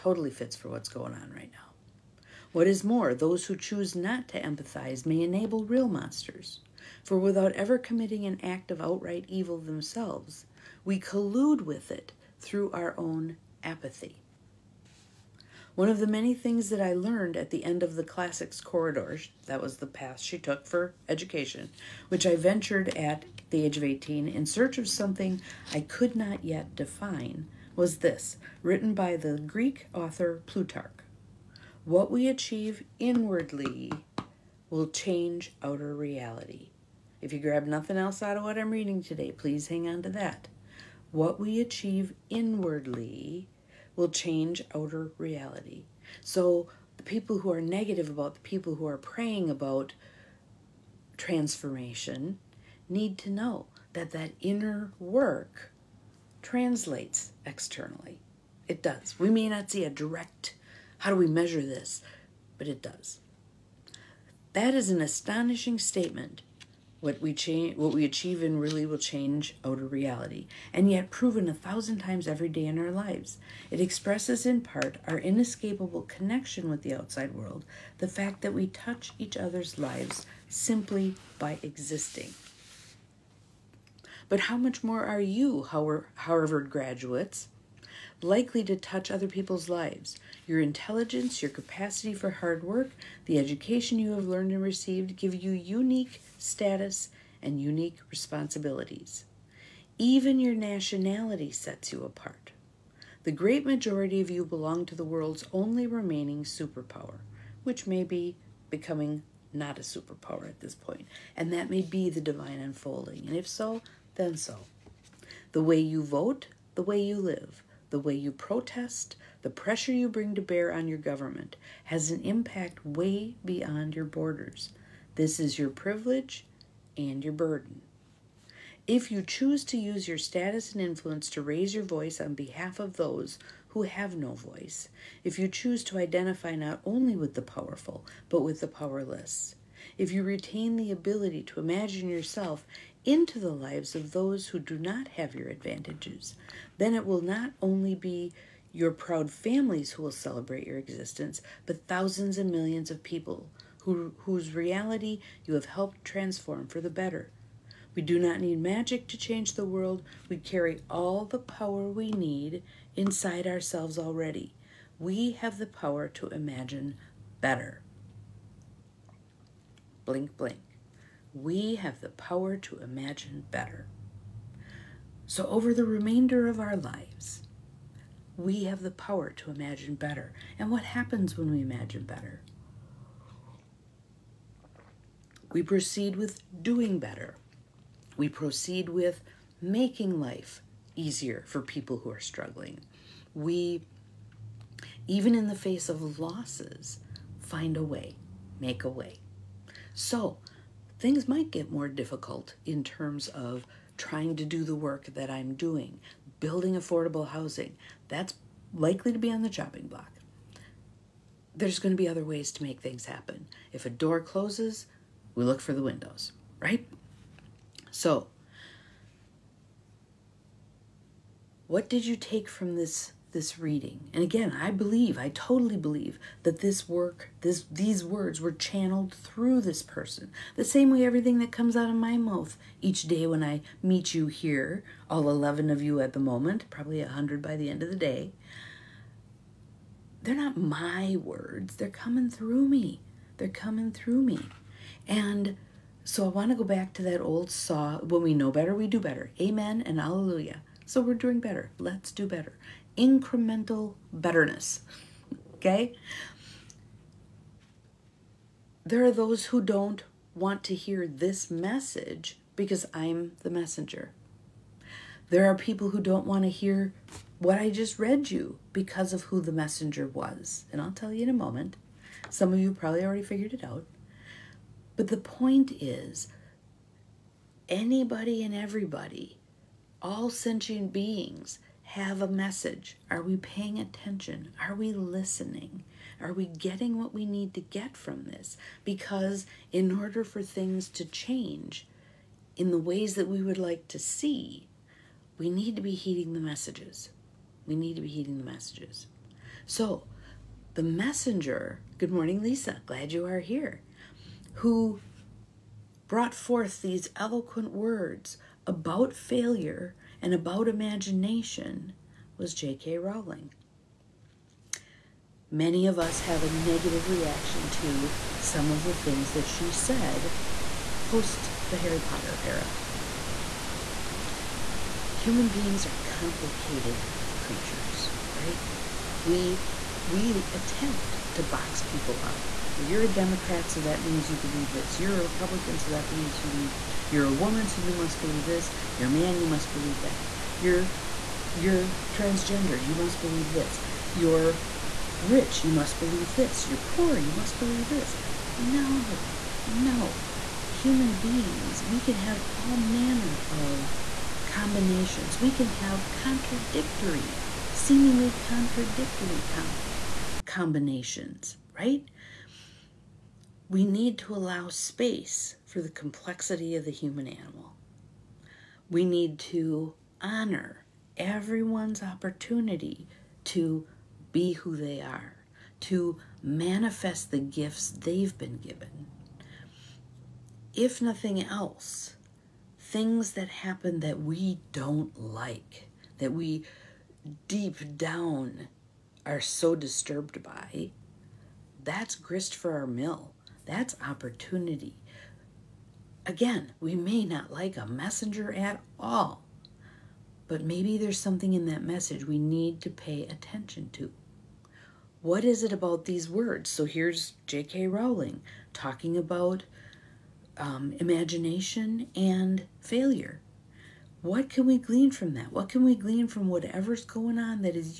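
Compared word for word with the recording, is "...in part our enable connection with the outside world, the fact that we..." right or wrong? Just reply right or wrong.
wrong.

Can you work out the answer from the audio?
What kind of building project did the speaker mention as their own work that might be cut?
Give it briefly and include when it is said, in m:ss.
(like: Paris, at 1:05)
affordable housing, at 3:26.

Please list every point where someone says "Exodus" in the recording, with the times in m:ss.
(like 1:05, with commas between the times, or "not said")
not said.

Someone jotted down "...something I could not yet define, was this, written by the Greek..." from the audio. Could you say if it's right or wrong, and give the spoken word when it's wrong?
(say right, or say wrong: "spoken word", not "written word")
right.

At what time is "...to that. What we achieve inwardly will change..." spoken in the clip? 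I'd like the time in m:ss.
0:40.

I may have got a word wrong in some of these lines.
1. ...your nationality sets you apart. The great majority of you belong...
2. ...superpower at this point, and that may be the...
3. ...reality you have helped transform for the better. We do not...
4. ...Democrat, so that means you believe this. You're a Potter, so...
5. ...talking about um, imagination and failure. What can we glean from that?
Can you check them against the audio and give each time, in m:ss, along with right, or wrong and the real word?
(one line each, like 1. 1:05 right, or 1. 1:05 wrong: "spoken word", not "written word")
1. 1:40 right
2. 1:49 right
3. 2:34 right
4. 5:33 wrong: "Republican", not "Potter"
5. 6:48 right.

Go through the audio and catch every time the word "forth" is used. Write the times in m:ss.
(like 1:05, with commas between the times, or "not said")
5:06.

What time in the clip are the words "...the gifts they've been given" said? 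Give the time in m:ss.
6:17.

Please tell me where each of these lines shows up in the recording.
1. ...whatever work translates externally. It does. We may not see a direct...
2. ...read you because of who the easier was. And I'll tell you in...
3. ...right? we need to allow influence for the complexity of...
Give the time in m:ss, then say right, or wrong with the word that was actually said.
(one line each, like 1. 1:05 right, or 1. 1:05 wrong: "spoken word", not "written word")
1. 0:54 wrong: "inner", not "whatever"
2. 4:27 wrong: "messenger", not "easier"
3. 6:01 wrong: "space", not "influence".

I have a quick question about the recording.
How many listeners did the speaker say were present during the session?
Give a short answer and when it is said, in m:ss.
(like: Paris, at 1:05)
11, at 3:55.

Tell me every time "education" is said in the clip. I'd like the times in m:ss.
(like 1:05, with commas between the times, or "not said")
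0:21, 1:33.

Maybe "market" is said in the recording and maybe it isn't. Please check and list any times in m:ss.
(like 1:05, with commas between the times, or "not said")
not said.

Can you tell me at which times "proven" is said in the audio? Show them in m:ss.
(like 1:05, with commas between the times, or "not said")
1:11.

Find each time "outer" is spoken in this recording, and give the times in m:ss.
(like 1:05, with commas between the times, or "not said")
0:35, 0:44, 1:09.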